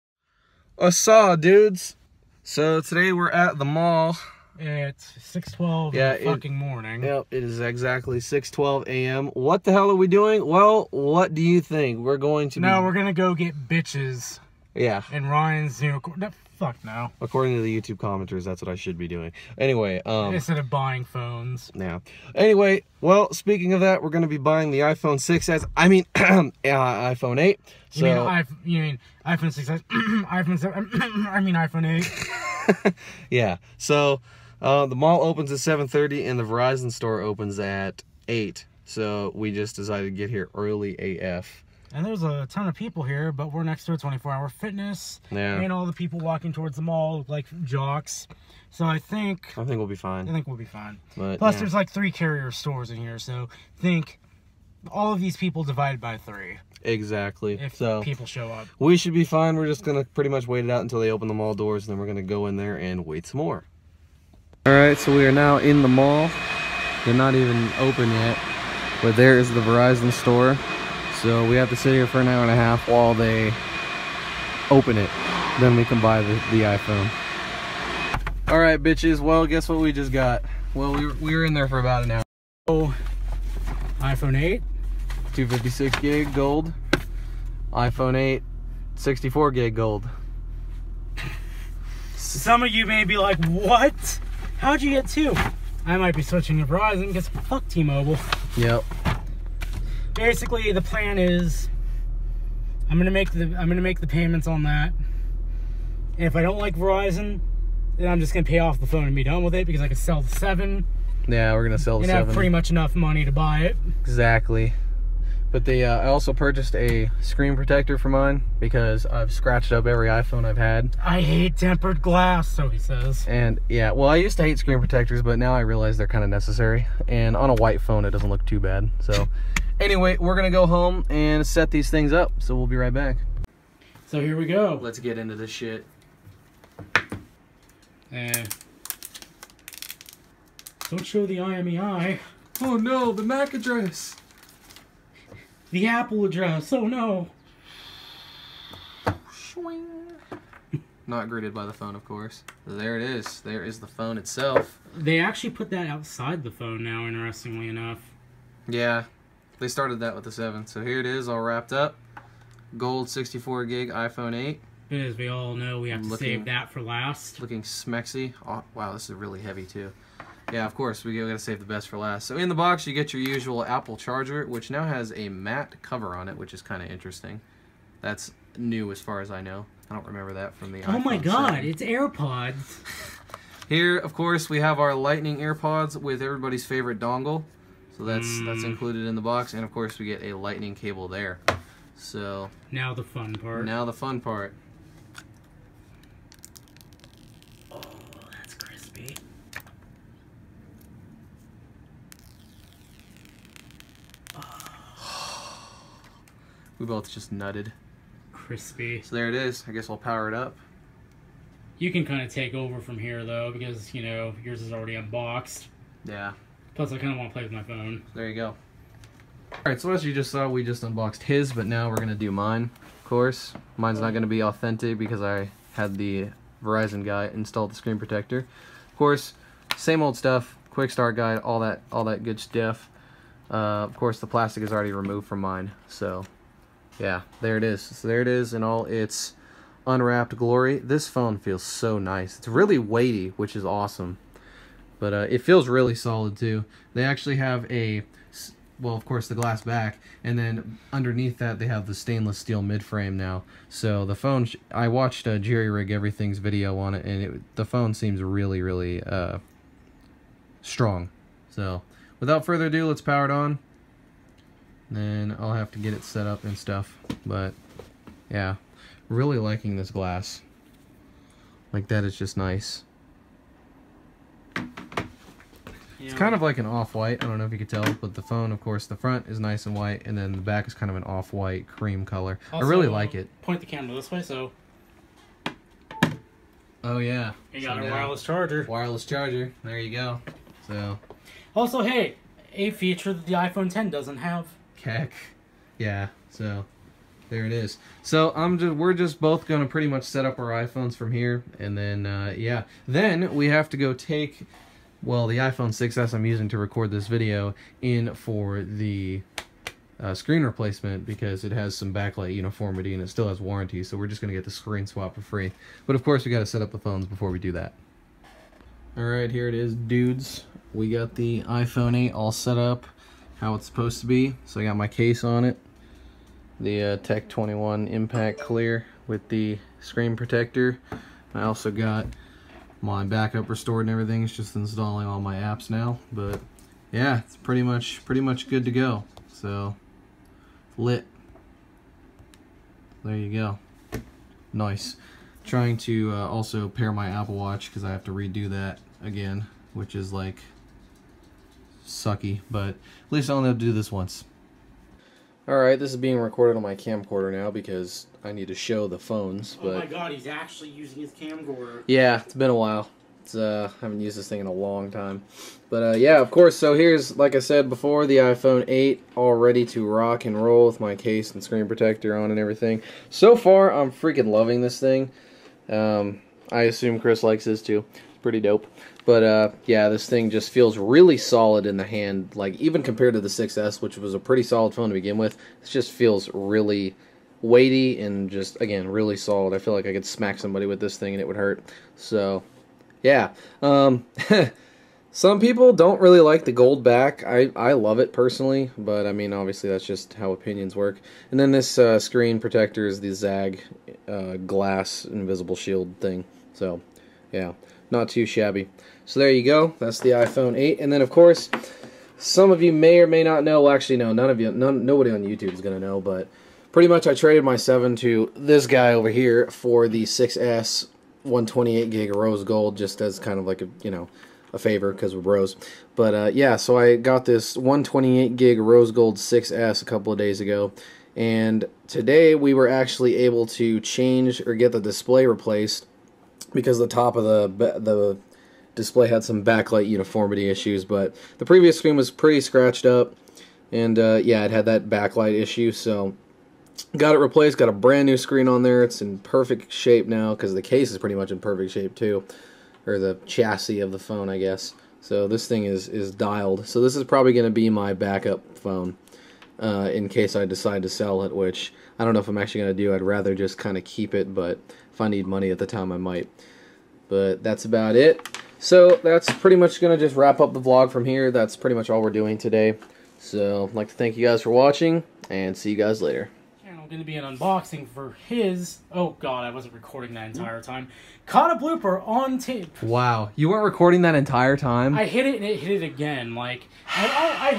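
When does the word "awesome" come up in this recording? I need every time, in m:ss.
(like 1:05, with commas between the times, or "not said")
4:03.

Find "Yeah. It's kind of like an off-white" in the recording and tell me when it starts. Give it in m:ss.
4:36.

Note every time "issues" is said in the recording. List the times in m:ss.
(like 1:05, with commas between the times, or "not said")
7:20, 7:25.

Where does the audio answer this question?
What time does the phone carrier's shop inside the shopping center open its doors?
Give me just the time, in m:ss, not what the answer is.
0:36.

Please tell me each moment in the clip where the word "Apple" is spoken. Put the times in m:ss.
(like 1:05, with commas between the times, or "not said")
2:25, 2:53, 5:47.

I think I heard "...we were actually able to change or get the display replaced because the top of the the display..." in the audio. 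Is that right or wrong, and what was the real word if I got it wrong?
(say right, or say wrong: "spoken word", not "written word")
right.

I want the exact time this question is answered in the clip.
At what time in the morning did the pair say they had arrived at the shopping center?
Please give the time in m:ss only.
0:08.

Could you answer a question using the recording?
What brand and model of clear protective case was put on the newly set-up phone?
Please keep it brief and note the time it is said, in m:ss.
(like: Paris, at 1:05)
Tech 21 Impact Clear, at 5:26.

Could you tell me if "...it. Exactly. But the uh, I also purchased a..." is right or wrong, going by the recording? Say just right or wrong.
right.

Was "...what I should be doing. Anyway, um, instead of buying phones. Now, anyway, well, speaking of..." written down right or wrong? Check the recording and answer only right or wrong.
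right.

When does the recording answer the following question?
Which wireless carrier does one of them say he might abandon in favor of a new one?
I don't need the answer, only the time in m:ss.
1:37.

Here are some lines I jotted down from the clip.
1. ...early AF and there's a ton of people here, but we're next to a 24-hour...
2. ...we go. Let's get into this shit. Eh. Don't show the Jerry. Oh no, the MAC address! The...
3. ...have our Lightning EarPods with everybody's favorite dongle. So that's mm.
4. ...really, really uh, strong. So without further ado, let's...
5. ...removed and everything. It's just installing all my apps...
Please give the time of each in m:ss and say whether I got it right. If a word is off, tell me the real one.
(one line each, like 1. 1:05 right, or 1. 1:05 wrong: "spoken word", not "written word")
1. 0:40 right
2. 2:14 wrong: "IMEI", not "Jerry"
3. 3:04 right
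4. 4:18 right
5. 5:33 wrong: "restored", not "removed".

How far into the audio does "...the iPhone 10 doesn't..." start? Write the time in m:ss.
4:53.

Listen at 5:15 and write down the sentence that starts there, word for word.
But of course, we got to set up the phones before we do that.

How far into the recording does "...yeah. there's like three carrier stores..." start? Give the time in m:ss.
0:51.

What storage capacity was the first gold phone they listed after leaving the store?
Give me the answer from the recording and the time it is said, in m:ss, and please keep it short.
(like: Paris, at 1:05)
256 GB, at 1:25.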